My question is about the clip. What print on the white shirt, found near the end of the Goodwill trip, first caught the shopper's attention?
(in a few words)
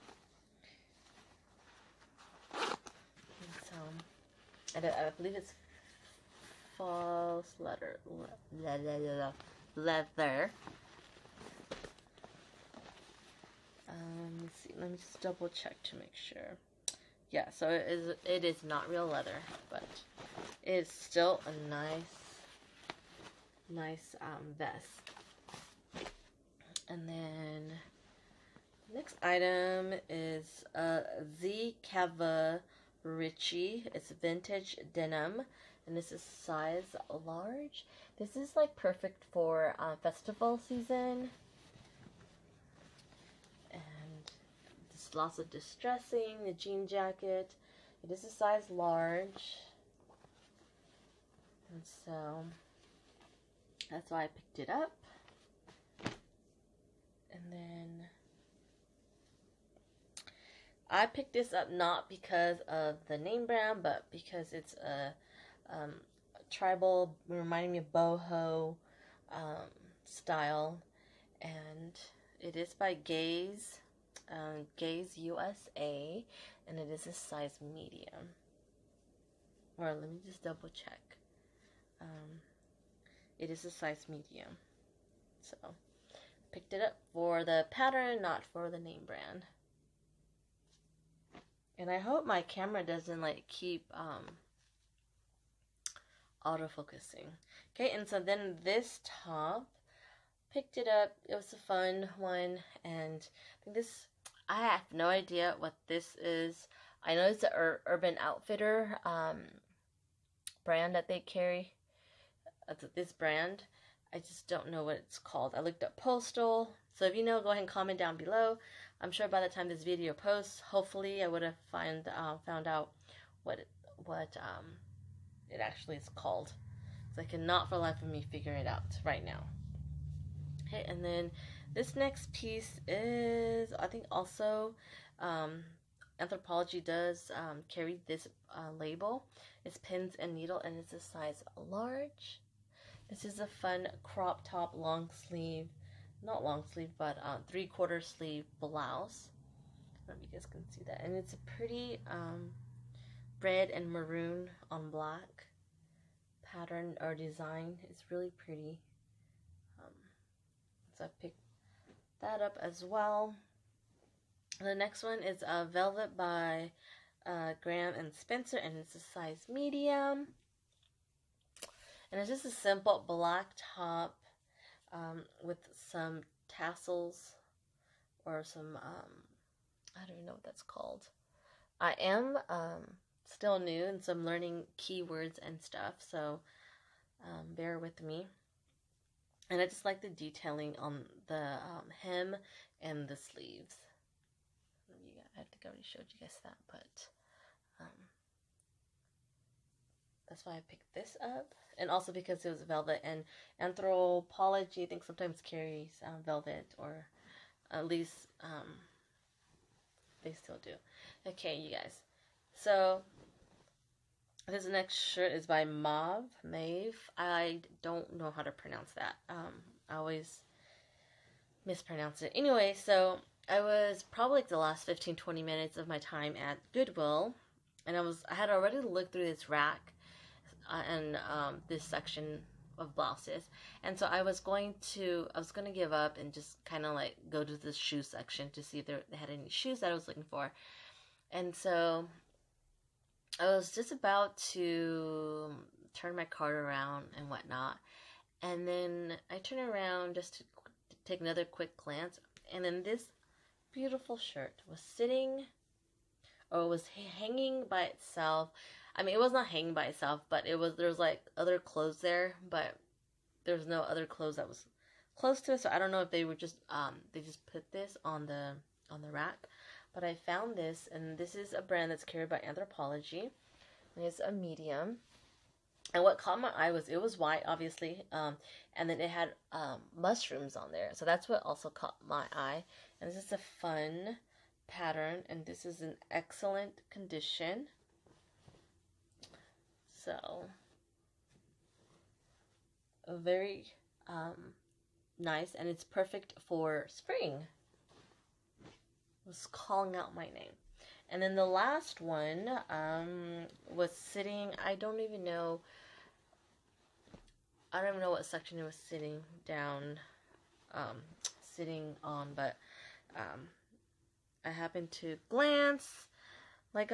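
Mushrooms.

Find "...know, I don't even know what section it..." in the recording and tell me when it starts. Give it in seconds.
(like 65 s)
305 s.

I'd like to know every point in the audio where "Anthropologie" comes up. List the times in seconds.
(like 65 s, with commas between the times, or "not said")
136 s, 203 s, 272 s.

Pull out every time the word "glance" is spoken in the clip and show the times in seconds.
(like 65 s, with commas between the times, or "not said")
251 s, 315 s.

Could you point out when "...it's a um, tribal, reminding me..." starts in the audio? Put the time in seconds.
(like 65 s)
64 s.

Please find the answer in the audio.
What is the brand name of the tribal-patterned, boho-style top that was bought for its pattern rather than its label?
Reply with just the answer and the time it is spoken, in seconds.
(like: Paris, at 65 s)
Gaze USA, at 74 s.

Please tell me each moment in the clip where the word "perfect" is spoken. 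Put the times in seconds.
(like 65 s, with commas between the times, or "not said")
38 s, 295 s.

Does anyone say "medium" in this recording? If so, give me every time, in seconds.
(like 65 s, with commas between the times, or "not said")
77 s, 84 s, 169 s, 274 s.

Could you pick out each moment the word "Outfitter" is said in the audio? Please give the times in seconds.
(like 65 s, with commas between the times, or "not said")
108 s.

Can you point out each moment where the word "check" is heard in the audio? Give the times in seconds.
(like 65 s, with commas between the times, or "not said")
15 s, 80 s.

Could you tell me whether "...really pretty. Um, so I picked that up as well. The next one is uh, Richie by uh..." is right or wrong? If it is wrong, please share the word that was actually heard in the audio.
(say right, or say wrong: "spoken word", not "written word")
wrong: "Velvet", not "Richie".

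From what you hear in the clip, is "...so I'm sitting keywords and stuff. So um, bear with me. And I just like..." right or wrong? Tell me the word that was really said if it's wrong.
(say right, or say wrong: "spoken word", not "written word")
wrong: "learning", not "sitting".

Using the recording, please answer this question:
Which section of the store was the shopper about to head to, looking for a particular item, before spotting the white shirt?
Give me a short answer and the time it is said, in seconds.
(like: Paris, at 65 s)
The shoe section, at 237 s.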